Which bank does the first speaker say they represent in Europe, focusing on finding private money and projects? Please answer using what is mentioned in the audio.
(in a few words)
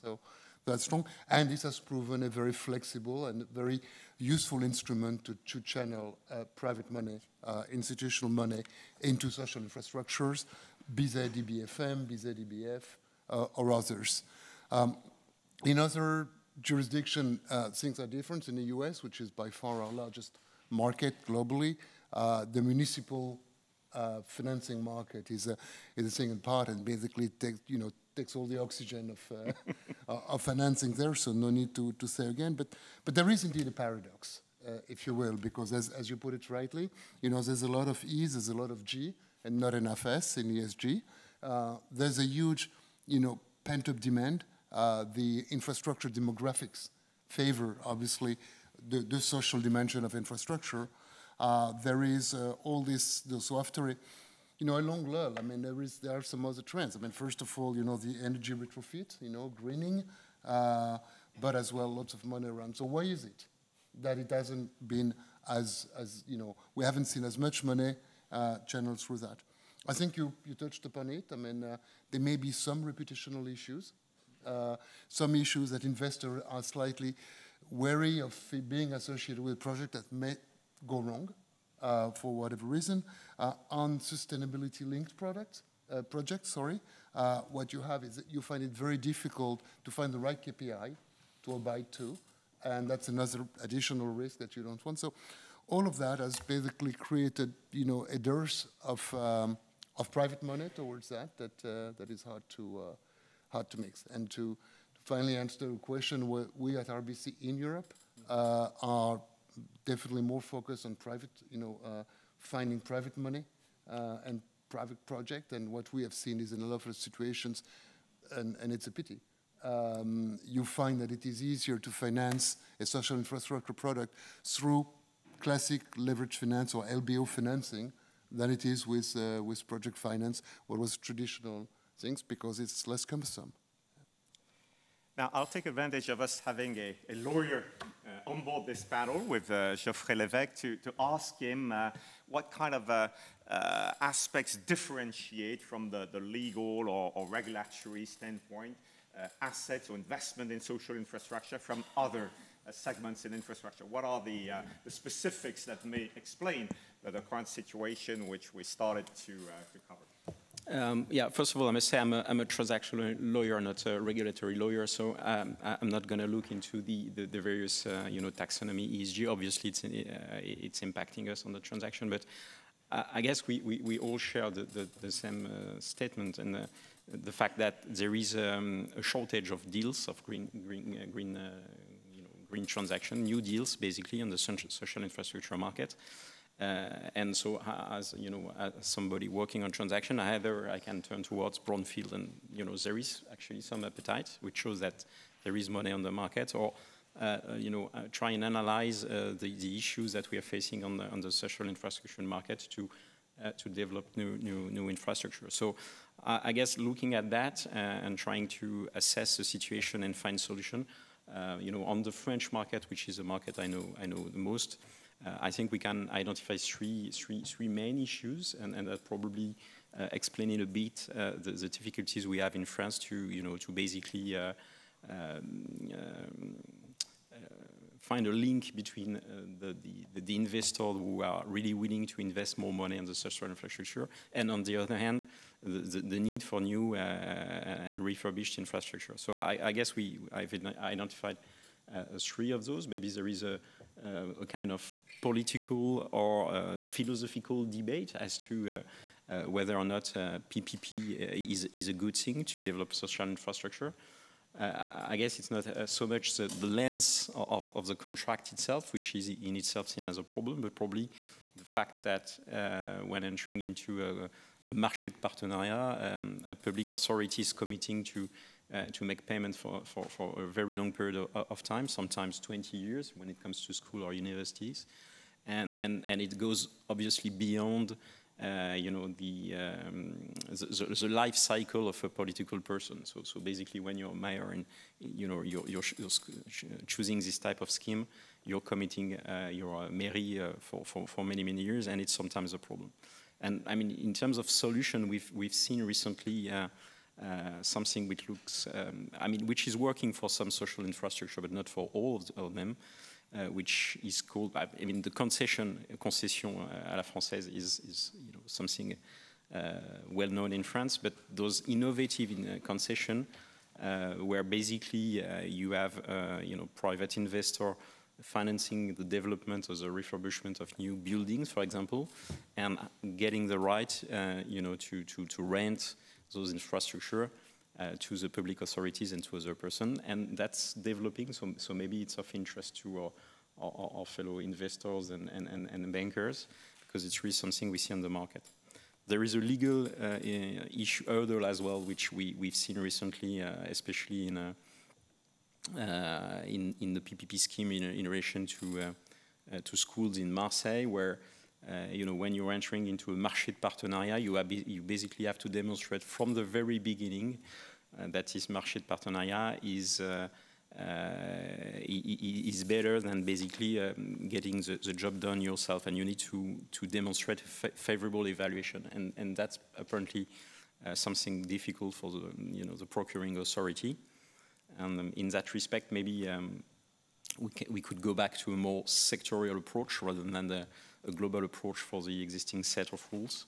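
RBC.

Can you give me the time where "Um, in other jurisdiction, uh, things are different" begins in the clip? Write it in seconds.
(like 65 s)
14 s.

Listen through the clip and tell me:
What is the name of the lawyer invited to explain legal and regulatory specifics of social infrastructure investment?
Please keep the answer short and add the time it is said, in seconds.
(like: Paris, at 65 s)
Geoffrey Levesque, at 139 s.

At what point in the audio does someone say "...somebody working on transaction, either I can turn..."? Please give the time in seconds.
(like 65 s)
188 s.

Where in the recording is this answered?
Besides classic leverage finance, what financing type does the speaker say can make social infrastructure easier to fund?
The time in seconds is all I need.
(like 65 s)
126 s.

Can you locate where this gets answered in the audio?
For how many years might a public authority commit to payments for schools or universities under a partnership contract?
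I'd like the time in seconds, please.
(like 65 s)
272 s.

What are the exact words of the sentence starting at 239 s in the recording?
So I, I guess we I've identified three of those.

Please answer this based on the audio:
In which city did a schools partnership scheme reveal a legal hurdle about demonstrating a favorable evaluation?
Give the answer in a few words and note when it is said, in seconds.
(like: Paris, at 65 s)
Marseille, at 350 s.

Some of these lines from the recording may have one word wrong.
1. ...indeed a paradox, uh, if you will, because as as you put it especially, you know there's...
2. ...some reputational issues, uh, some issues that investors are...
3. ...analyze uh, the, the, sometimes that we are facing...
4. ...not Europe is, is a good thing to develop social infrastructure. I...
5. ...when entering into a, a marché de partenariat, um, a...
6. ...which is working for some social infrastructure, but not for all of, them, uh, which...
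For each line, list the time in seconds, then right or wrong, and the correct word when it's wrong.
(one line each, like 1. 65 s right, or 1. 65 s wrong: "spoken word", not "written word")
1. 33 s wrong: "rightly", not "especially"
2. 72 s right
3. 198 s wrong: "issues", not "sometimes"
4. 249 s wrong: "PPP", not "Europe"
5. 263 s right
6. 299 s right.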